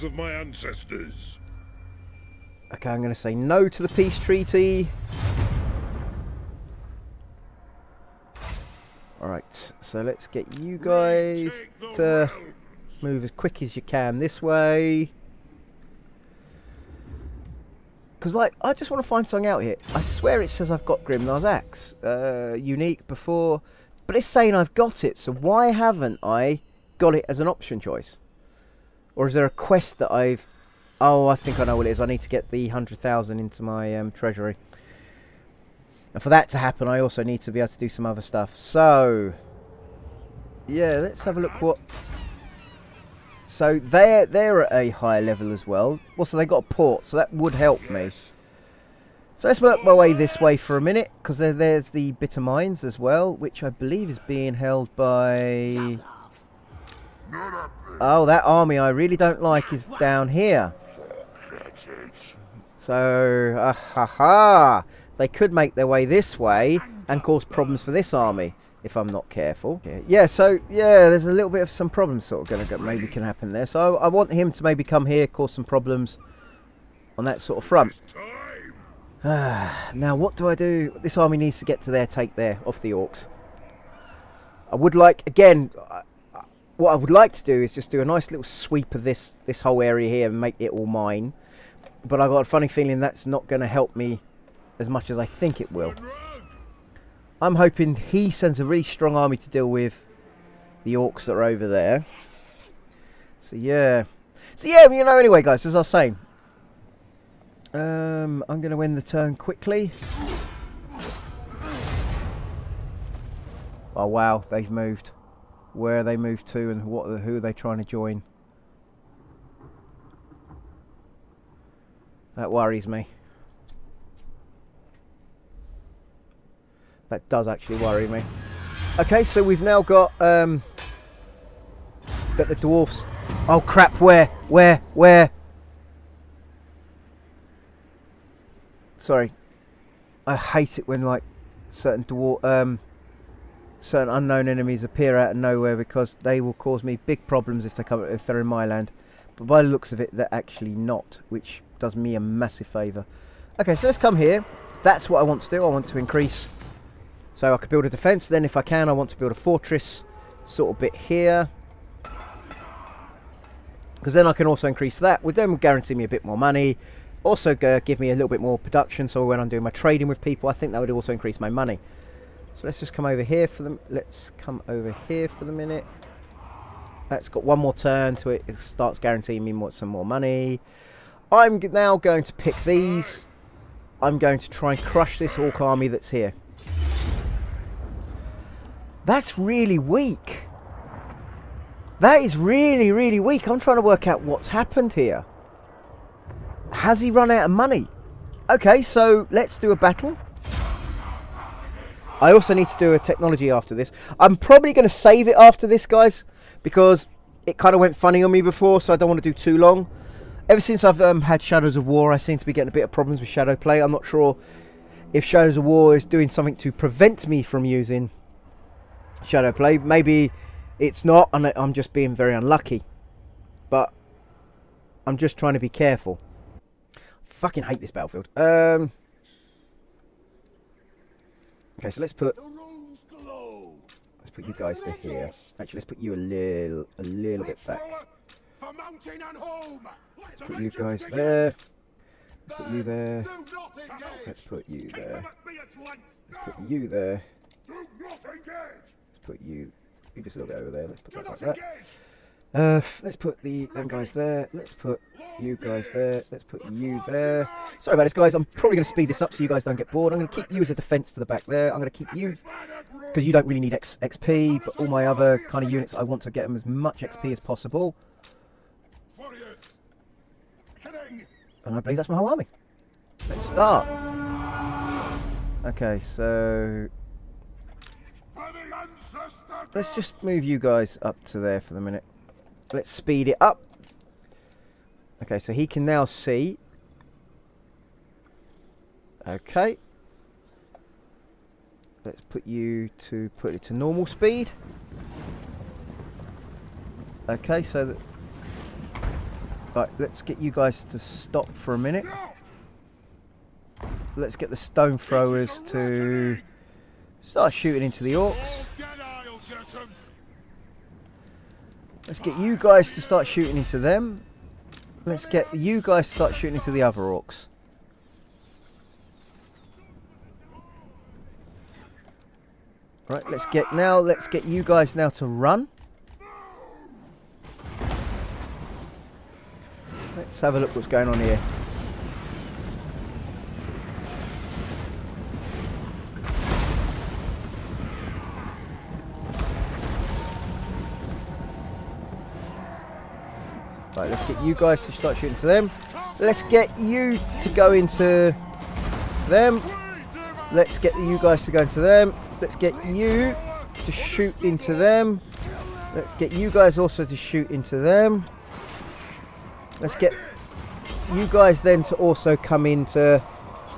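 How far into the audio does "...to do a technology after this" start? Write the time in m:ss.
3:22.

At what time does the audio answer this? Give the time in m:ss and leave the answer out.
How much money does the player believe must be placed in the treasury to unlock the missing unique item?
0:32.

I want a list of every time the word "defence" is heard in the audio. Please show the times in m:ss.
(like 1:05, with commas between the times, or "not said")
2:37, 4:20.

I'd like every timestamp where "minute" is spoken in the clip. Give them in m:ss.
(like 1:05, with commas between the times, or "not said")
0:50, 2:55, 4:41, 5:01.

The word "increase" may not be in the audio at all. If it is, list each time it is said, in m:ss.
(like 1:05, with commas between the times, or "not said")
2:35, 2:44, 2:51.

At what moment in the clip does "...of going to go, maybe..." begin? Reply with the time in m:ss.
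1:12.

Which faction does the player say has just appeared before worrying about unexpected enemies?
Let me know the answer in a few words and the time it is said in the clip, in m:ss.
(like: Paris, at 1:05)
Dwarfs, at 2:12.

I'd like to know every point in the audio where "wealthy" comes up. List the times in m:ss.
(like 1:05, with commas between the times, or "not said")
not said.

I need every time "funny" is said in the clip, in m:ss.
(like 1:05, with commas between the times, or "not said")
1:32, 3:27.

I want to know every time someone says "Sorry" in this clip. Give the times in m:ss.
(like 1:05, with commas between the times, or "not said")
2:18, 4:17.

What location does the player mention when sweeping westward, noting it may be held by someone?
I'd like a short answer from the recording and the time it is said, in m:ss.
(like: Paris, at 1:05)
Bitter Mines, at 0:52.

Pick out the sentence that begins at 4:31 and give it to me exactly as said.
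And I believe that's my whole army.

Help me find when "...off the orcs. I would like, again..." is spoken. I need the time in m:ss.
1:22.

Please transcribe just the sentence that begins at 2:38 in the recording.
Then if I can, I want to build a fortress sort of bit here.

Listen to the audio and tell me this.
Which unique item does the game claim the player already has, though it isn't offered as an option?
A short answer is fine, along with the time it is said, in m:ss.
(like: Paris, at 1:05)
Grimnir's Axe, at 0:21.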